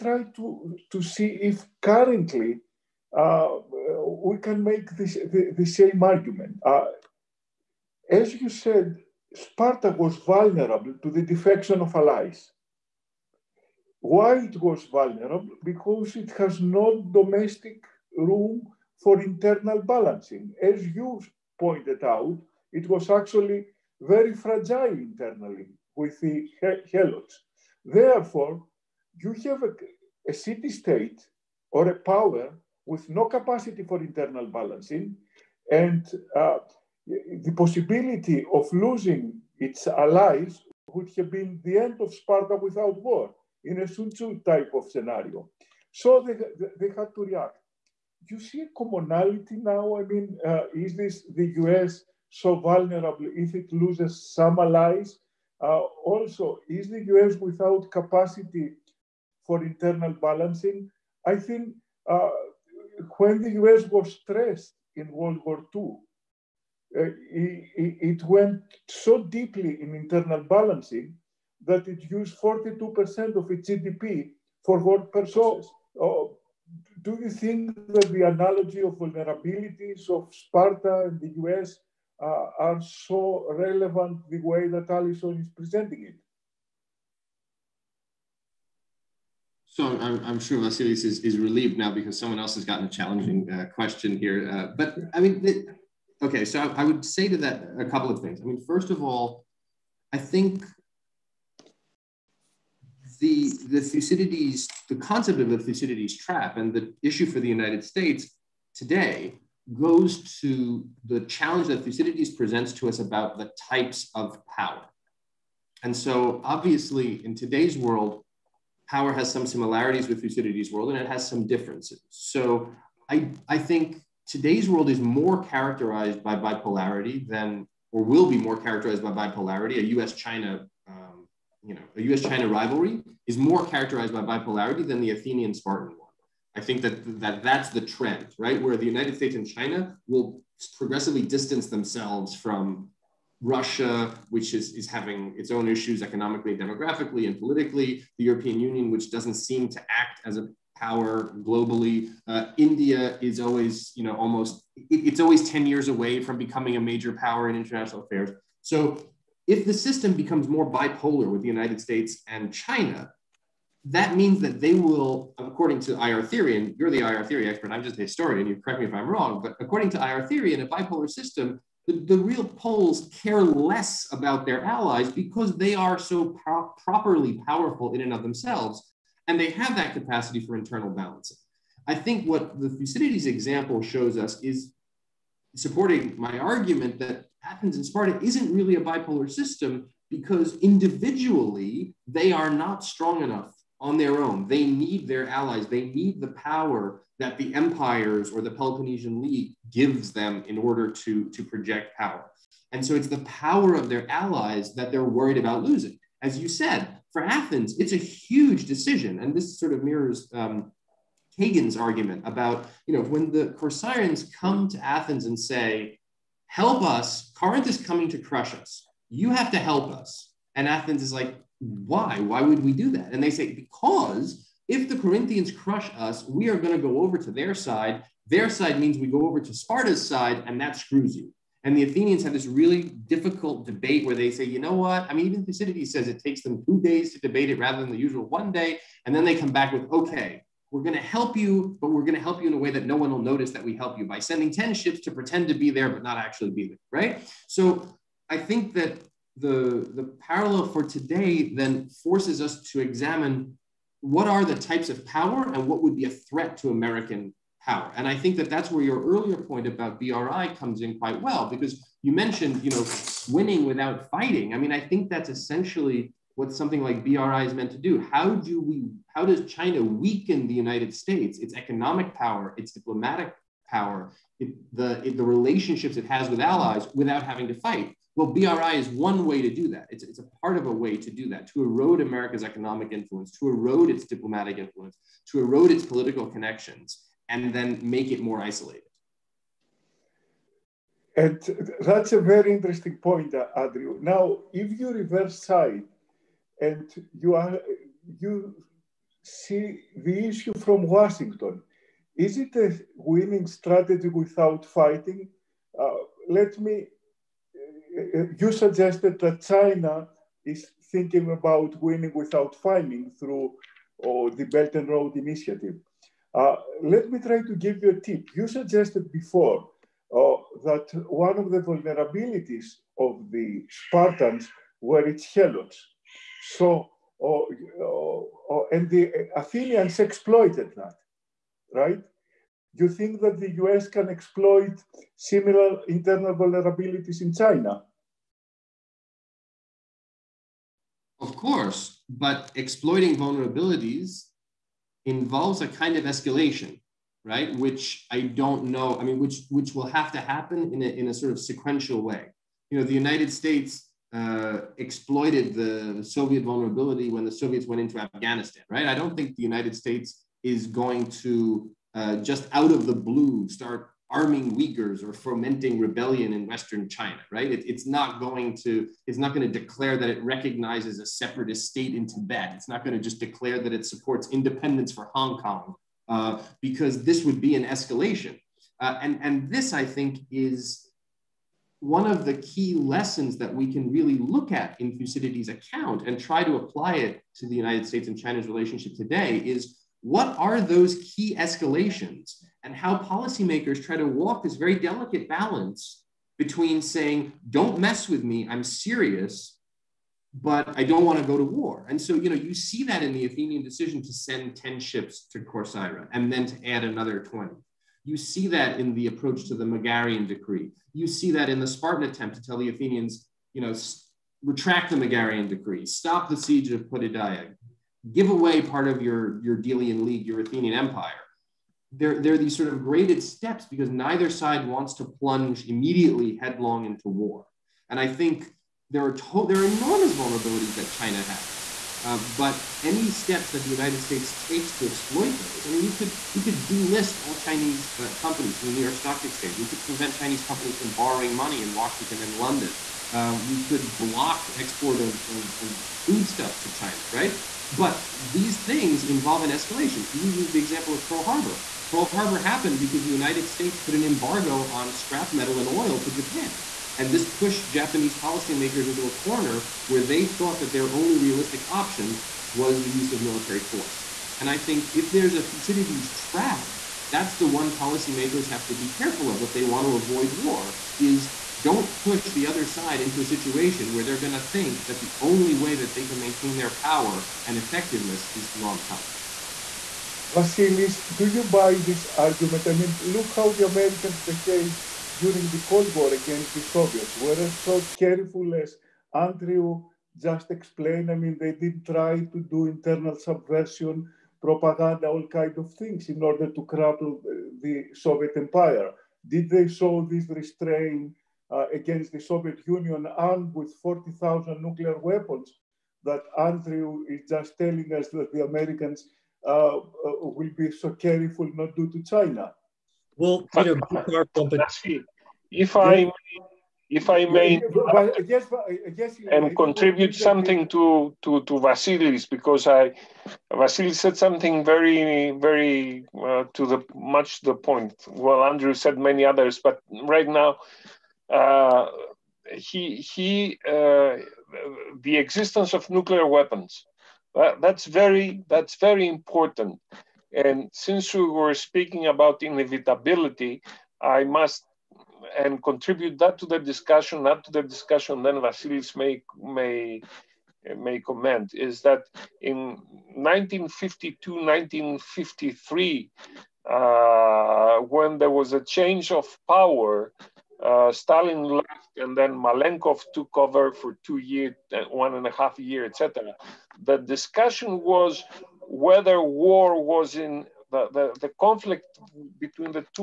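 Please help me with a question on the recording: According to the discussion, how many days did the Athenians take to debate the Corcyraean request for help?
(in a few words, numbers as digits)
2.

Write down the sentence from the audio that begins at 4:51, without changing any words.
And that's a very interesting point, Andrew.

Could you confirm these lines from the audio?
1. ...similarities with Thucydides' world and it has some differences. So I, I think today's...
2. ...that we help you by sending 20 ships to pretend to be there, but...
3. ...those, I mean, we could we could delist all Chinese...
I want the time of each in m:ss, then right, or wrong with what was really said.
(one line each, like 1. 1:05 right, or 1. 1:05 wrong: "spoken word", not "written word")
1. 1:59 right
2. 4:03 wrong: "10", not "20"
3. 7:15 right.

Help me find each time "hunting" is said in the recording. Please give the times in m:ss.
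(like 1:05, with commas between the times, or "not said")
not said.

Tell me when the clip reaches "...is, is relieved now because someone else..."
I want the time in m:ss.
1:31.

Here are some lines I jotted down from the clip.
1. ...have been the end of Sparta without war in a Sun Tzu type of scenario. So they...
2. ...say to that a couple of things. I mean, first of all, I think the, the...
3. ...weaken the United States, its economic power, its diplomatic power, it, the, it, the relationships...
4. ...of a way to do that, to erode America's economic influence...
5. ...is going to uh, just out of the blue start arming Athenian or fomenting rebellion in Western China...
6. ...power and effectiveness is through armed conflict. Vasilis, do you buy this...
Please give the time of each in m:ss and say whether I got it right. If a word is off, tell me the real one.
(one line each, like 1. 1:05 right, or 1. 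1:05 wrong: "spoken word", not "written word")
1. 0:41 right
2. 1:37 right
3. 4:29 right
4. 4:40 right
5. 6:00 wrong: "Uyghurs", not "Athenian"
6. 7:56 right.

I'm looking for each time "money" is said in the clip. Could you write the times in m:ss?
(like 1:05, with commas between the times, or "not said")
7:21.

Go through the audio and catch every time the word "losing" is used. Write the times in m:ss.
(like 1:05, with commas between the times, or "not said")
0:38, 3:25.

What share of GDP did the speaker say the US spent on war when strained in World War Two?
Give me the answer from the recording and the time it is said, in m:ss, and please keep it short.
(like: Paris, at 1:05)
42%, at 1:12.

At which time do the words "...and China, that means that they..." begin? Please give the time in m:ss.
2:42.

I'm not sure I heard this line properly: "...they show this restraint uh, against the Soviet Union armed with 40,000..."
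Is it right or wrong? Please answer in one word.
right.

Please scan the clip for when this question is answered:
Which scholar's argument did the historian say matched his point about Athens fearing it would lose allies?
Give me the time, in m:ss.
3:31.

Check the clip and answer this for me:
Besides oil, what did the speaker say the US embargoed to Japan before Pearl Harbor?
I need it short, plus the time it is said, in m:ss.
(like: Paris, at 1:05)
Scrap metal, at 7:34.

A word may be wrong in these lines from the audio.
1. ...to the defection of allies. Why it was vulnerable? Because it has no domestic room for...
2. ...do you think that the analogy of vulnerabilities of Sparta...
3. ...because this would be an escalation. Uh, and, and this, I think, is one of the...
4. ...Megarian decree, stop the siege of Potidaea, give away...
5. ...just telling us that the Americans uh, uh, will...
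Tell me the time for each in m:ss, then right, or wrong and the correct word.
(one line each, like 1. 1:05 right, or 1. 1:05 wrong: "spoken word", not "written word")
1. 0:11 right
2. 1:17 right
3. 6:16 right
4. 6:54 right
5. 8:27 right.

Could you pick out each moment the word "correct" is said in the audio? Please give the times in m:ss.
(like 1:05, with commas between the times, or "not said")
2:48.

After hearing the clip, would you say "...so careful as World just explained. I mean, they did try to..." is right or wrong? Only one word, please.
wrong.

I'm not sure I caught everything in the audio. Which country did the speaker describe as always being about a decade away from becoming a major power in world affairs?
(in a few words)
India.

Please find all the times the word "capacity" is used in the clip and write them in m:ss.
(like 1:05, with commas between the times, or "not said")
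0:33, 0:57, 2:59.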